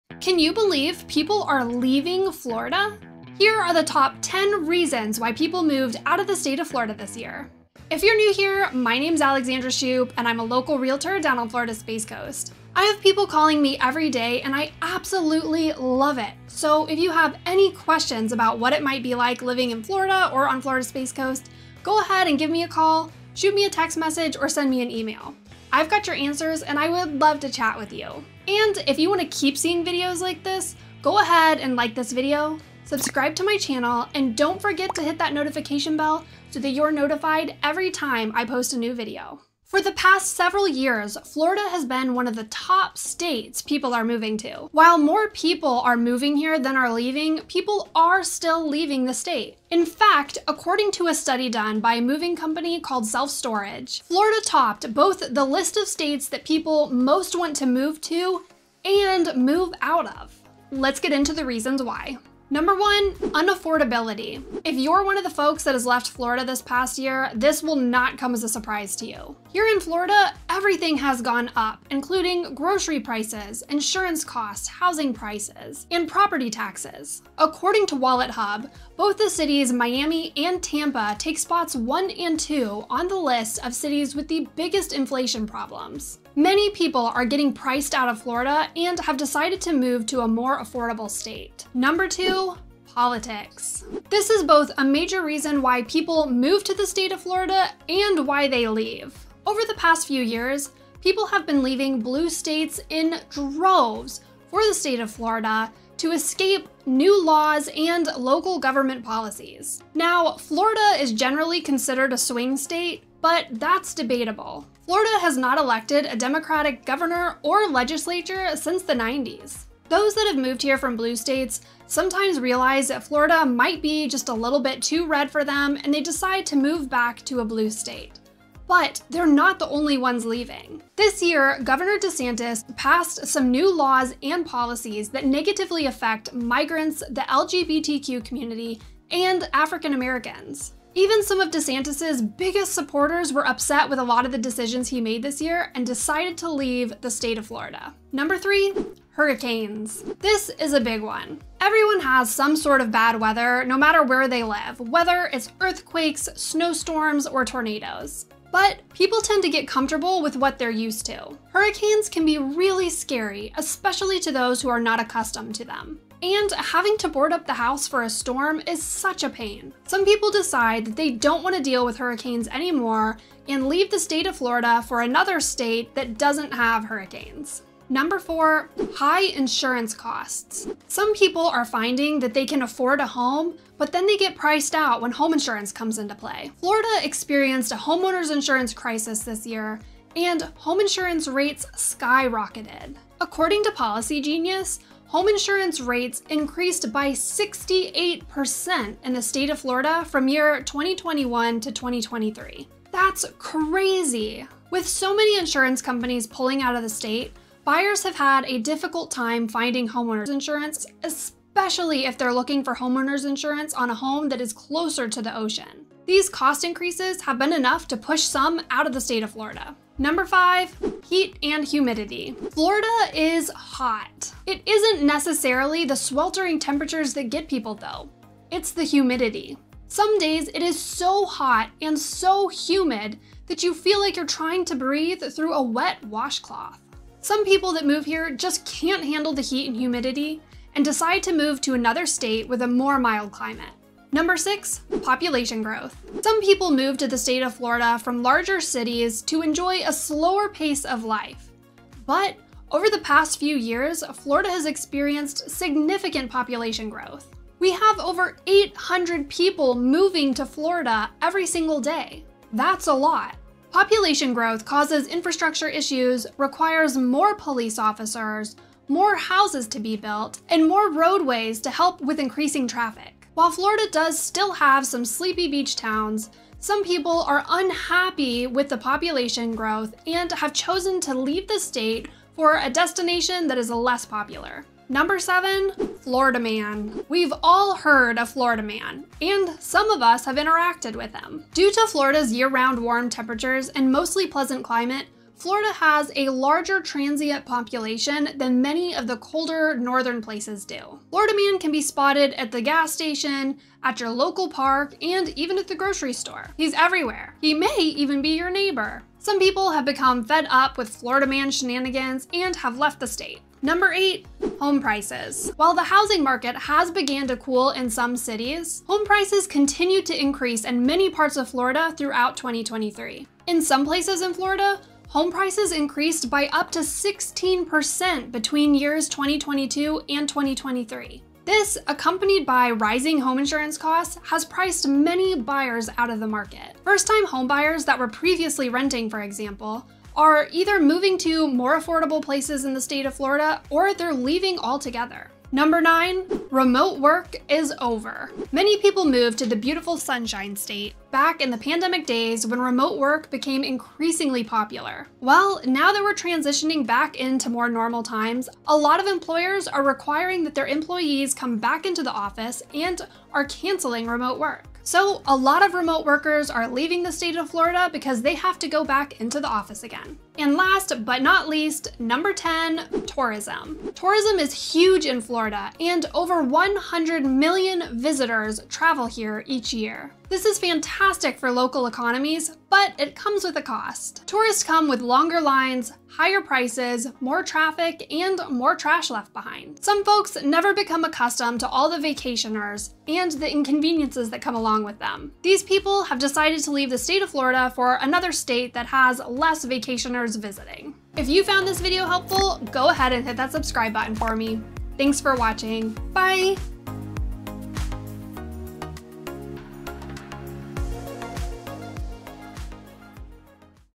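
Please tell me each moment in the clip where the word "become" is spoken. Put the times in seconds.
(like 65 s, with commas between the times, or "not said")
309 s, 390 s.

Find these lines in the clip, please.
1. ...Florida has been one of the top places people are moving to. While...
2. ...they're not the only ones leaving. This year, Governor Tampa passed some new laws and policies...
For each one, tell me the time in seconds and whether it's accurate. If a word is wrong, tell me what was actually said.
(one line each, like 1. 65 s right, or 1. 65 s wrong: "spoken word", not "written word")
1. 41 s wrong: "states", not "places"
2. 129 s wrong: "DeSantis", not "Tampa".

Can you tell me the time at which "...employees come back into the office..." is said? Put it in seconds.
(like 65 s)
360 s.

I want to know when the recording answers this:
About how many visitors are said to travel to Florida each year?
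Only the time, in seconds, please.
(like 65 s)
376 s.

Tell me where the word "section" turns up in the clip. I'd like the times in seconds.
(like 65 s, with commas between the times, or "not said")
not said.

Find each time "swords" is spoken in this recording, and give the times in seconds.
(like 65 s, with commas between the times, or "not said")
not said.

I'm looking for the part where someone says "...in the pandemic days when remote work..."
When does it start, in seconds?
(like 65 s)
351 s.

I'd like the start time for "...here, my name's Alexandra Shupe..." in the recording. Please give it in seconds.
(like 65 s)
8 s.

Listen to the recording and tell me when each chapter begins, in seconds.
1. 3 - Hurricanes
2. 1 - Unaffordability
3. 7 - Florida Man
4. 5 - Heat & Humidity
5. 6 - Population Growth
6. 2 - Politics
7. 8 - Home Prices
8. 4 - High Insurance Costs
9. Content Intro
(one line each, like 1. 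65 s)
1. 149 s
2. 63 s
3. 286 s
4. 220 s
5. 245 s
6. 92 s
7. 314 s
8. 179 s
9. 39 s.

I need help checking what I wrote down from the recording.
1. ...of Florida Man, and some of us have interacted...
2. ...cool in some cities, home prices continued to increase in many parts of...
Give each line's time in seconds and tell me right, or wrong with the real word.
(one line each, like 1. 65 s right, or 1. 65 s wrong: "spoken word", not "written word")
1. 288 s right
2. 317 s right.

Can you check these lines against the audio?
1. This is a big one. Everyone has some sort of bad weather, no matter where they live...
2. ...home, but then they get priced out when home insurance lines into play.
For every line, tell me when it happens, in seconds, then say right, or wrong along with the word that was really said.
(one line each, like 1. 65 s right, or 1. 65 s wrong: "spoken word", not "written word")
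1. 150 s right
2. 183 s wrong: "comes", not "lines".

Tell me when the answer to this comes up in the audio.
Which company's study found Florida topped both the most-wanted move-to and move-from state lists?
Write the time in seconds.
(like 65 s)
53 s.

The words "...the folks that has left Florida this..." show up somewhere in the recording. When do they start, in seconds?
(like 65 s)
65 s.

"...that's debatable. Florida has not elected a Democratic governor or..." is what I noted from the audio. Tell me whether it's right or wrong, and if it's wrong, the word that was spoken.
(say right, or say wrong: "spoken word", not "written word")
right.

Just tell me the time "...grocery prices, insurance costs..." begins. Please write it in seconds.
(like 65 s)
72 s.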